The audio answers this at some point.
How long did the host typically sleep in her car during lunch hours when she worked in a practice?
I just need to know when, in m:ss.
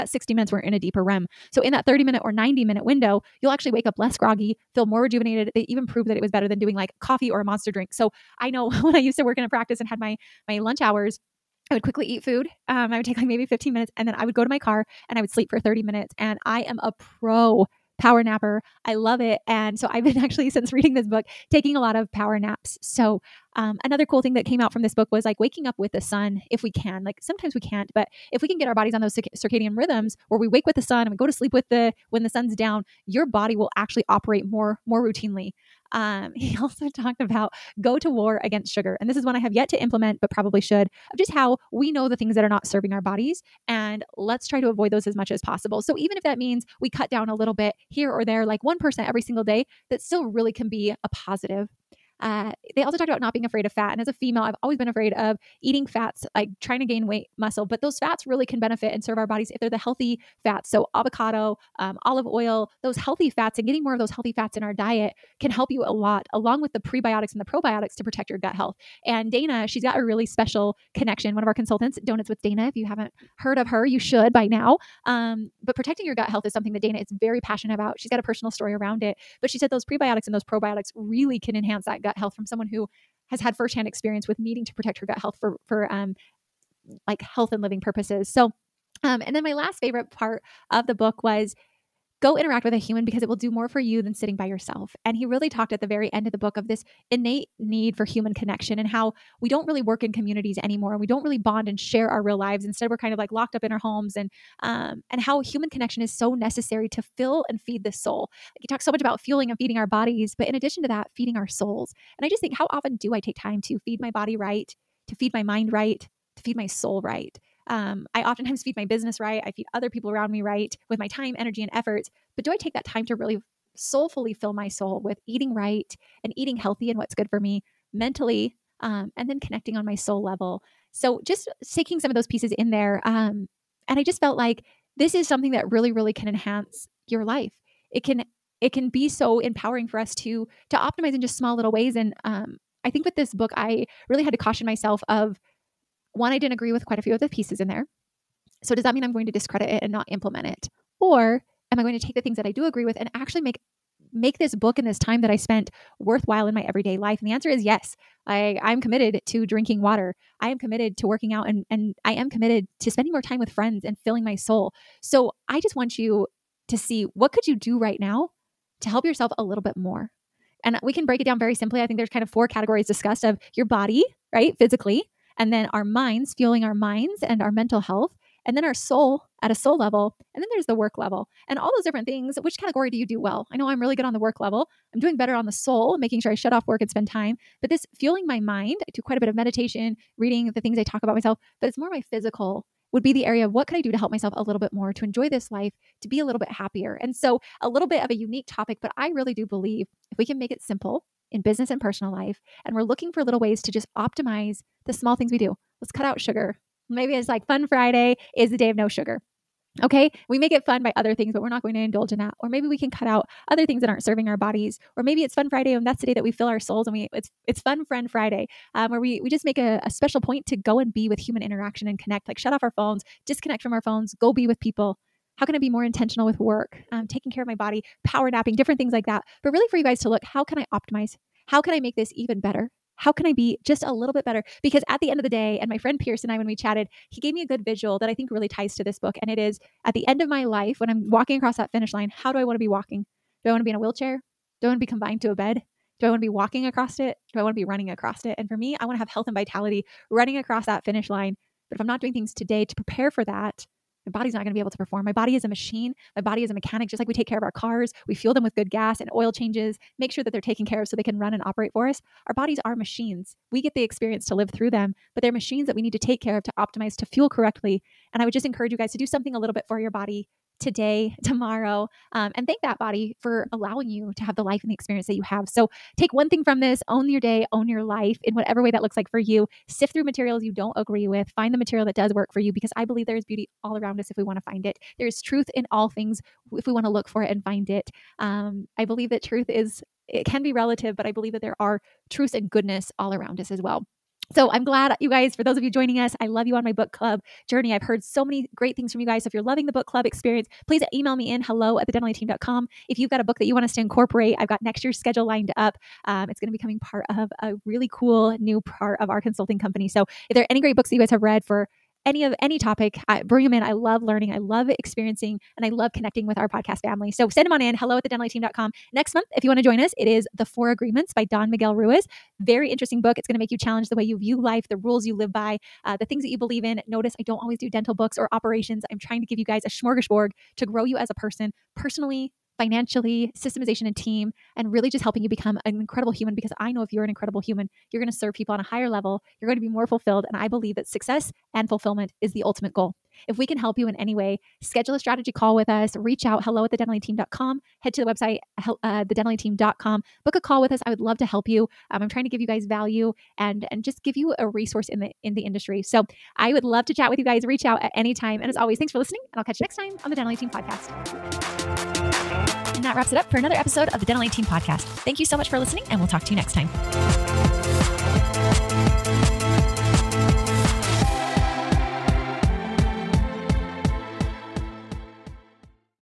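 0:15.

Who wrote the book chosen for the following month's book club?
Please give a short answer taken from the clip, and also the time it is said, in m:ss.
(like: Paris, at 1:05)
Don Miguel Ruiz, at 5:21.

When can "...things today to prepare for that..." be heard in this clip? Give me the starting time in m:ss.
4:12.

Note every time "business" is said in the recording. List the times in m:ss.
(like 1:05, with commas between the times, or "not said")
1:58, 3:21.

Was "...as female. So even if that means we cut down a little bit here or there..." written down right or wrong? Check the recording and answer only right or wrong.
wrong.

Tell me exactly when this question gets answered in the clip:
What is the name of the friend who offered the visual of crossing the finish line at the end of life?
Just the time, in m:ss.
3:55.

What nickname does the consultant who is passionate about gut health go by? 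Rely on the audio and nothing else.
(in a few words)
Donuts with Dana.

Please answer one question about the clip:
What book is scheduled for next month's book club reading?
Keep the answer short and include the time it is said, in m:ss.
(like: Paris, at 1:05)
The Four Agreements, at 5:20.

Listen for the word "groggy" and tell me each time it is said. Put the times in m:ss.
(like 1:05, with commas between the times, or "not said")
0:04.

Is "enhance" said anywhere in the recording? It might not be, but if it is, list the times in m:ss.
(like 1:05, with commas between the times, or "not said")
1:21, 2:16.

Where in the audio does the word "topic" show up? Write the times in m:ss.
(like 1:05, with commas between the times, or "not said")
3:18, 5:12.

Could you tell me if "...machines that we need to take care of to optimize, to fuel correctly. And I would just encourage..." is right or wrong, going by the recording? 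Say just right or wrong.
right.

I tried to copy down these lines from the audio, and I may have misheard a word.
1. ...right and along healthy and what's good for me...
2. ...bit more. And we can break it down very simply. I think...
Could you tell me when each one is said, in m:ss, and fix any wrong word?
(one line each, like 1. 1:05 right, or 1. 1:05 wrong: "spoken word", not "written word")
1. 2:05 wrong: "eating", not "along"
2. 2:49 right.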